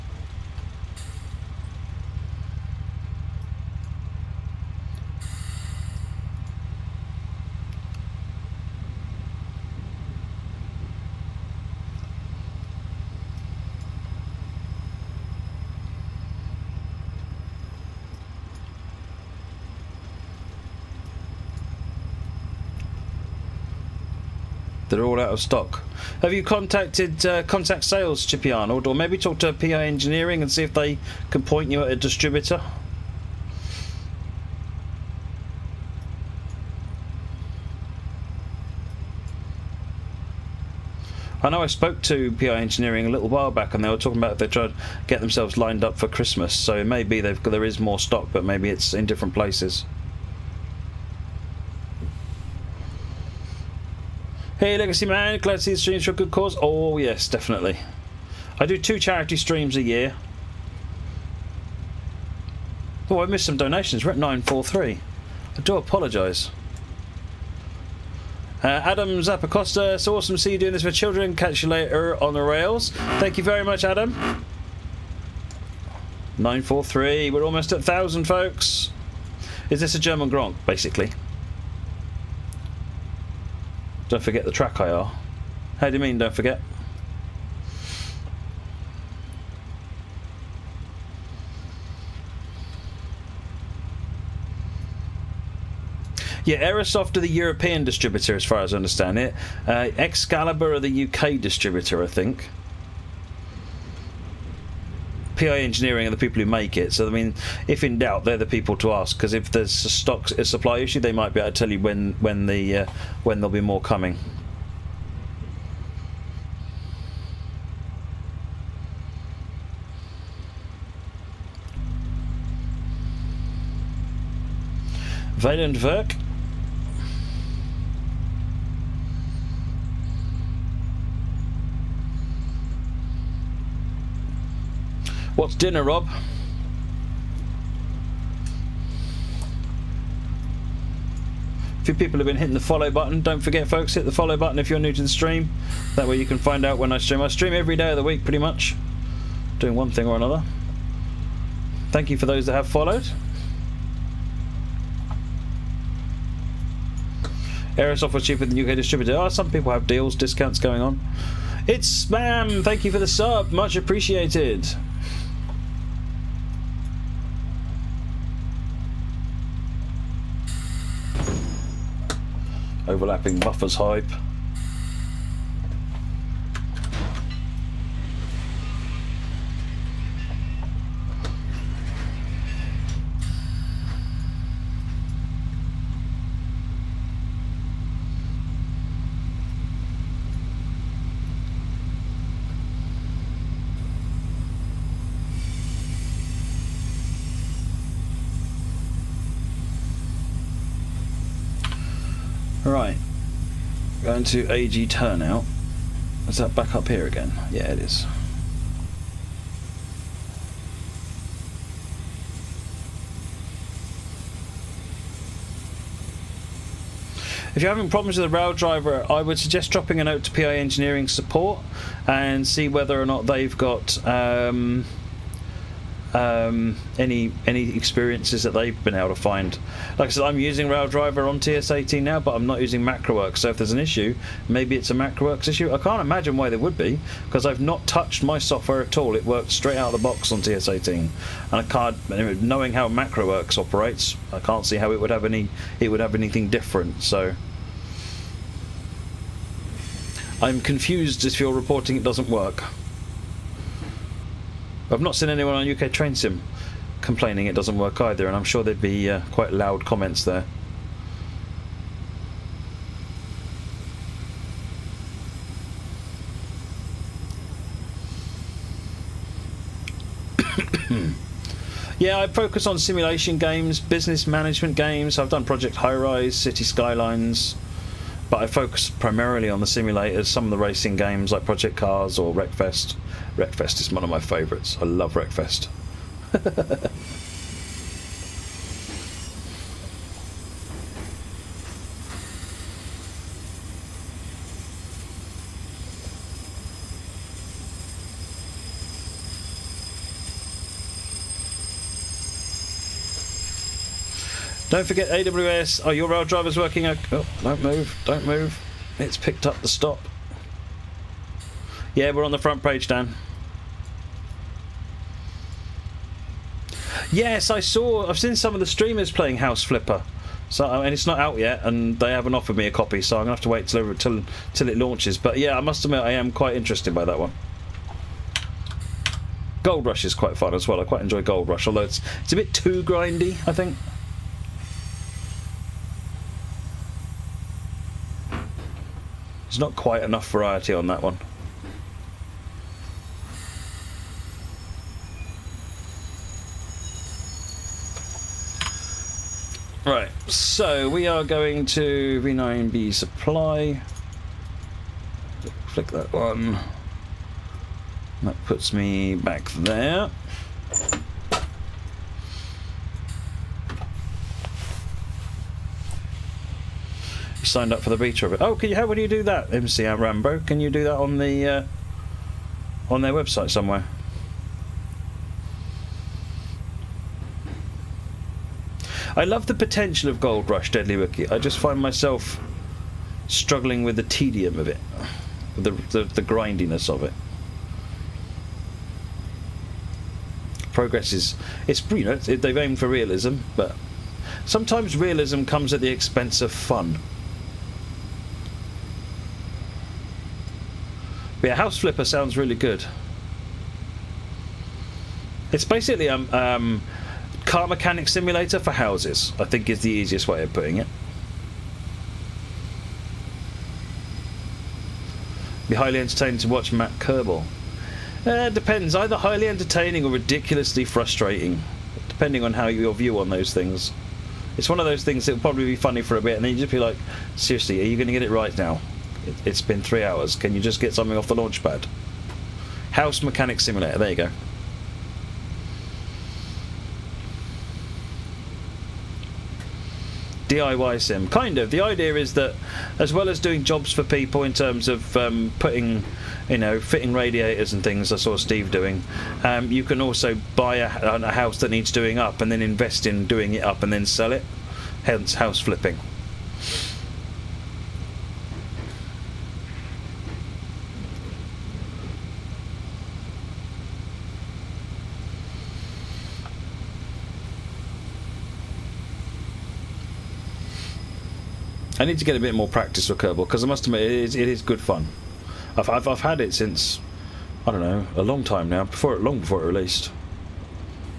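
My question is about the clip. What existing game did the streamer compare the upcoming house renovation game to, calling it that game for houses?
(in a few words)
Car Mechanic Simulator.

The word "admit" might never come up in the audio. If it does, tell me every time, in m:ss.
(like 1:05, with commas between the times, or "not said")
5:25, 7:53.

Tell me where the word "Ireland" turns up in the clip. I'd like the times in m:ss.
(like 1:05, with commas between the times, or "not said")
not said.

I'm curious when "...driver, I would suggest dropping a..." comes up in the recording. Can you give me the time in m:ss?
3:38.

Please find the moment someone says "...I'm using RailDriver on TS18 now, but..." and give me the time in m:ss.
3:50.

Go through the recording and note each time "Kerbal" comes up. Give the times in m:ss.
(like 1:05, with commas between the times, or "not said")
6:56, 7:53.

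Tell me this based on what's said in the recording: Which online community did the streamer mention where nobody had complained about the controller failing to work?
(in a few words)
UK Train Sim.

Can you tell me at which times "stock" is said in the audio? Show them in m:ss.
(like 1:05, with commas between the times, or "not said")
0:25, 0:47, 1:49.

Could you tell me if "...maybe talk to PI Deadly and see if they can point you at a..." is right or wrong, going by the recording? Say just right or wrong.
wrong.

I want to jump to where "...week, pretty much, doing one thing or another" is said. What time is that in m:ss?
2:28.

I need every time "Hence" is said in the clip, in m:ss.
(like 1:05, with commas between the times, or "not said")
7:35.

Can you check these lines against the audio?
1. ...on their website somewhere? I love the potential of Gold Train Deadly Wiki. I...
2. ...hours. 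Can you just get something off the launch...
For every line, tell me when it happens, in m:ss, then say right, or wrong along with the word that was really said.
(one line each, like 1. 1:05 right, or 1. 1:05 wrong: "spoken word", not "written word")
1. 6:12 wrong: "Rush", not "Train"
2. 7:10 right.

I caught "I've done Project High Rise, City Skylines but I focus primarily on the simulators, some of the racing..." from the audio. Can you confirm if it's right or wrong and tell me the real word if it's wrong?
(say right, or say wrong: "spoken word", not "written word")
right.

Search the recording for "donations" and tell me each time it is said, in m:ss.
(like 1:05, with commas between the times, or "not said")
1:03.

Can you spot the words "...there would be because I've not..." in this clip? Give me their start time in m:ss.
3:56.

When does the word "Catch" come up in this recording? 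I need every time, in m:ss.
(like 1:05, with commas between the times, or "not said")
1:11.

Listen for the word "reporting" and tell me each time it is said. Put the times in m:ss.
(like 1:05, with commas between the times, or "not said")
4:11.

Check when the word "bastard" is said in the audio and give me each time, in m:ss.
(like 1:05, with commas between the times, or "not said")
not said.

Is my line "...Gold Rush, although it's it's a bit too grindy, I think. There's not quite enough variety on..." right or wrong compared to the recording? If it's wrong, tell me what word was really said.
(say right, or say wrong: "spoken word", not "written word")
right.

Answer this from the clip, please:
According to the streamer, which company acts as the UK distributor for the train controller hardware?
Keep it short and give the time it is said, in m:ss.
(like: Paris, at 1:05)
Excalibur, at 1:39.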